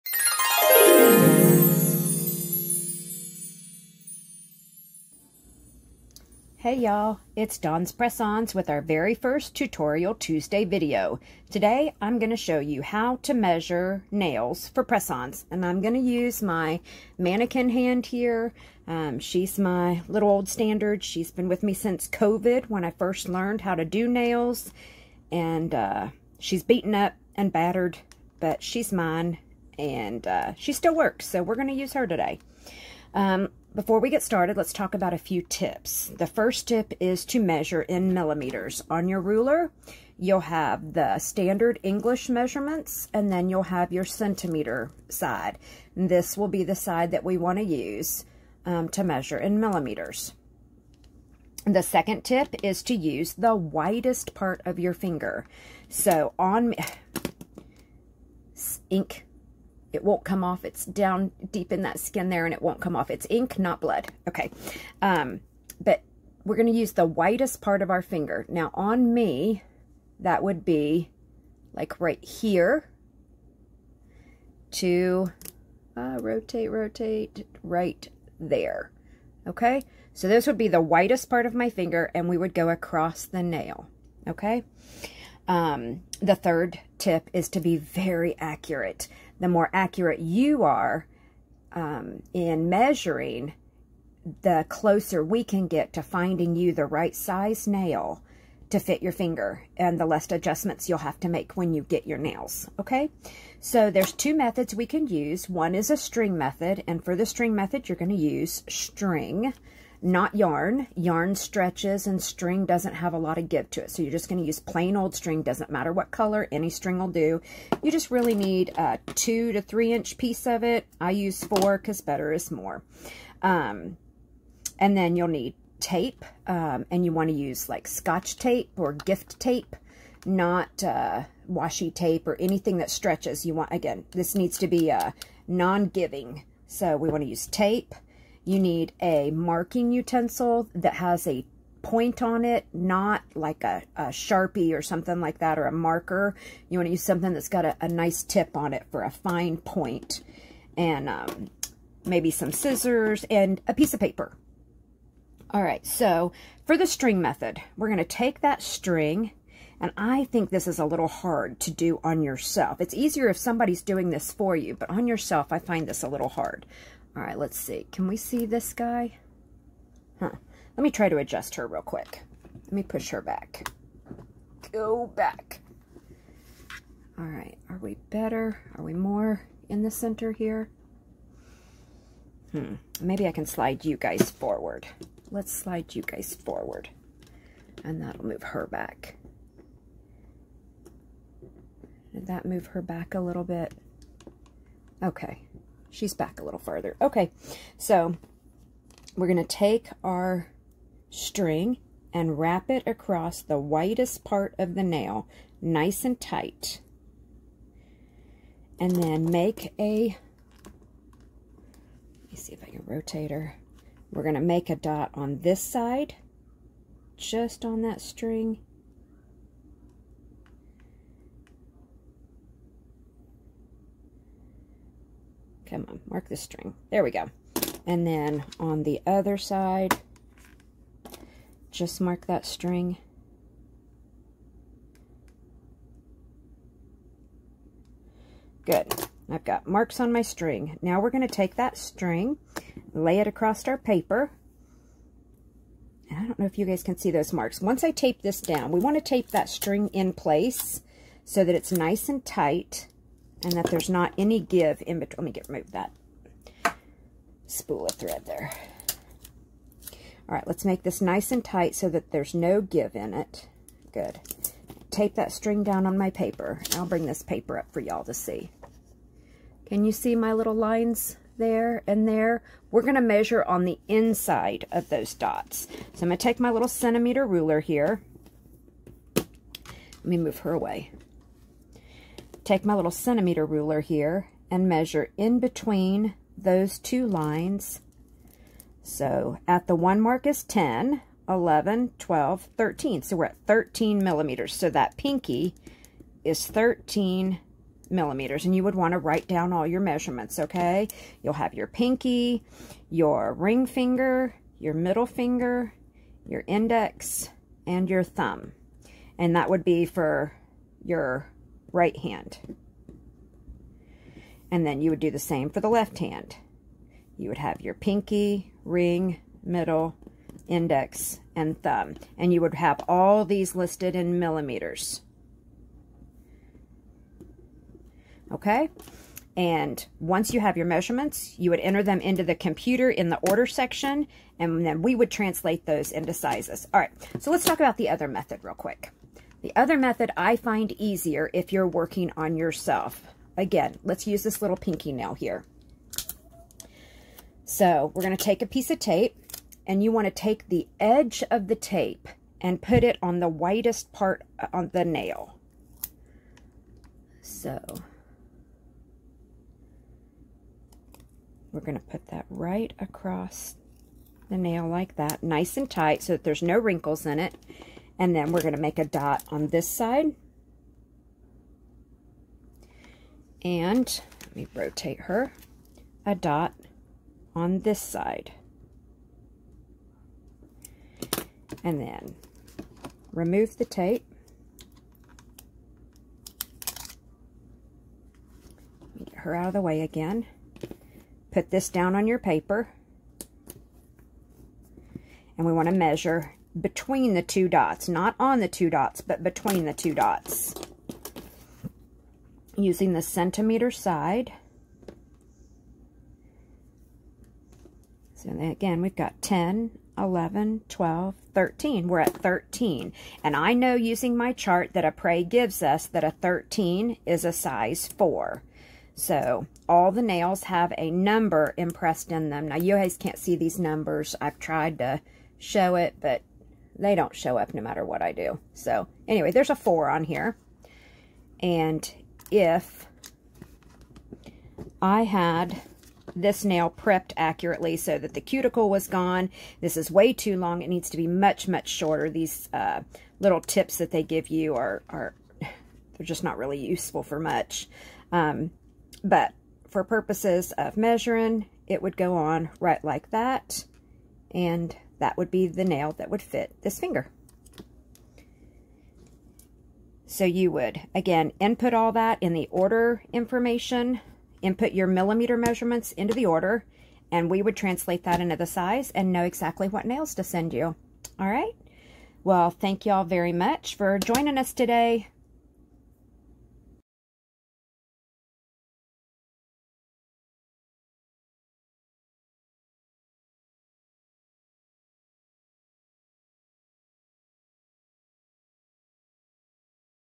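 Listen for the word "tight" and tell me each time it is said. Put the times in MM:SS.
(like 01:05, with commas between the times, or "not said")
03:26, 04:12, 04:21, 06:05.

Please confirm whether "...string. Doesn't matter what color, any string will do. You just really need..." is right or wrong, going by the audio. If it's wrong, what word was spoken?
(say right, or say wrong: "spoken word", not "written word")
right.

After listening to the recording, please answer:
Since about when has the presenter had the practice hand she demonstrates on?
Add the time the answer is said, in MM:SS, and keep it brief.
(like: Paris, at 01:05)
COVID, at 00:22.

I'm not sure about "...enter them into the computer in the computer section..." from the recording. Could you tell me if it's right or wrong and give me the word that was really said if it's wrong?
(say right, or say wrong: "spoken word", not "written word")
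wrong: "order", not "computer".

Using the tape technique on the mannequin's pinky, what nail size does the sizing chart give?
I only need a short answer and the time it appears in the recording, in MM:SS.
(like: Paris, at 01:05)
4, at 06:57.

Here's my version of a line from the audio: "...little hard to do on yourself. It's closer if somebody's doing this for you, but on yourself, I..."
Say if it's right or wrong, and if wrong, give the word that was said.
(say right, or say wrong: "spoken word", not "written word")
wrong: "easier", not "closer".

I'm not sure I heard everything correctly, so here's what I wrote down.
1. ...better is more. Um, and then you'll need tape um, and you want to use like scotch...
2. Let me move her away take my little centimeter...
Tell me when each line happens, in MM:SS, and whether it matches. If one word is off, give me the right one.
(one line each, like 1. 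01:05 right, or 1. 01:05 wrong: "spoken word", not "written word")
1. 02:02 right
2. 04:39 right.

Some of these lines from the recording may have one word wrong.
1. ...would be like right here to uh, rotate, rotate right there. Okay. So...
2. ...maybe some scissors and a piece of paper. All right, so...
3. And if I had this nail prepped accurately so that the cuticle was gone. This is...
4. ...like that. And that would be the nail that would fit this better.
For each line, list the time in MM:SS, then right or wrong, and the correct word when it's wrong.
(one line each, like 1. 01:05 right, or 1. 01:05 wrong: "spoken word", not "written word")
1. 01:10 right
2. 02:32 right
3. 07:11 right
4. 07:32 wrong: "finger", not "better".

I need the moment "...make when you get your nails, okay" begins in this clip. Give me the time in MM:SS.
01:41.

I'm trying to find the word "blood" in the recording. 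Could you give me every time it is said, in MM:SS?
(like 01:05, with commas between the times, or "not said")
01:03.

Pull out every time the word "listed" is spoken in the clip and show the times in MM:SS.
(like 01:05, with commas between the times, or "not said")
05:23.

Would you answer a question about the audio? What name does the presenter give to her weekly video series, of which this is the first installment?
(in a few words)
Tutorial Tuesday.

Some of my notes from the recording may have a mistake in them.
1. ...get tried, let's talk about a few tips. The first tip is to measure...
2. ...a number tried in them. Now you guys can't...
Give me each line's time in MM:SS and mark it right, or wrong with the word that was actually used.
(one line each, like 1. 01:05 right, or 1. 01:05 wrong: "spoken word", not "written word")
1. 00:34 wrong: "started", not "tried"
2. 07:00 wrong: "impressed", not "tried".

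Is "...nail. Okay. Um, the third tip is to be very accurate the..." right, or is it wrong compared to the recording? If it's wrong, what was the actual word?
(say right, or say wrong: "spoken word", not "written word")
right.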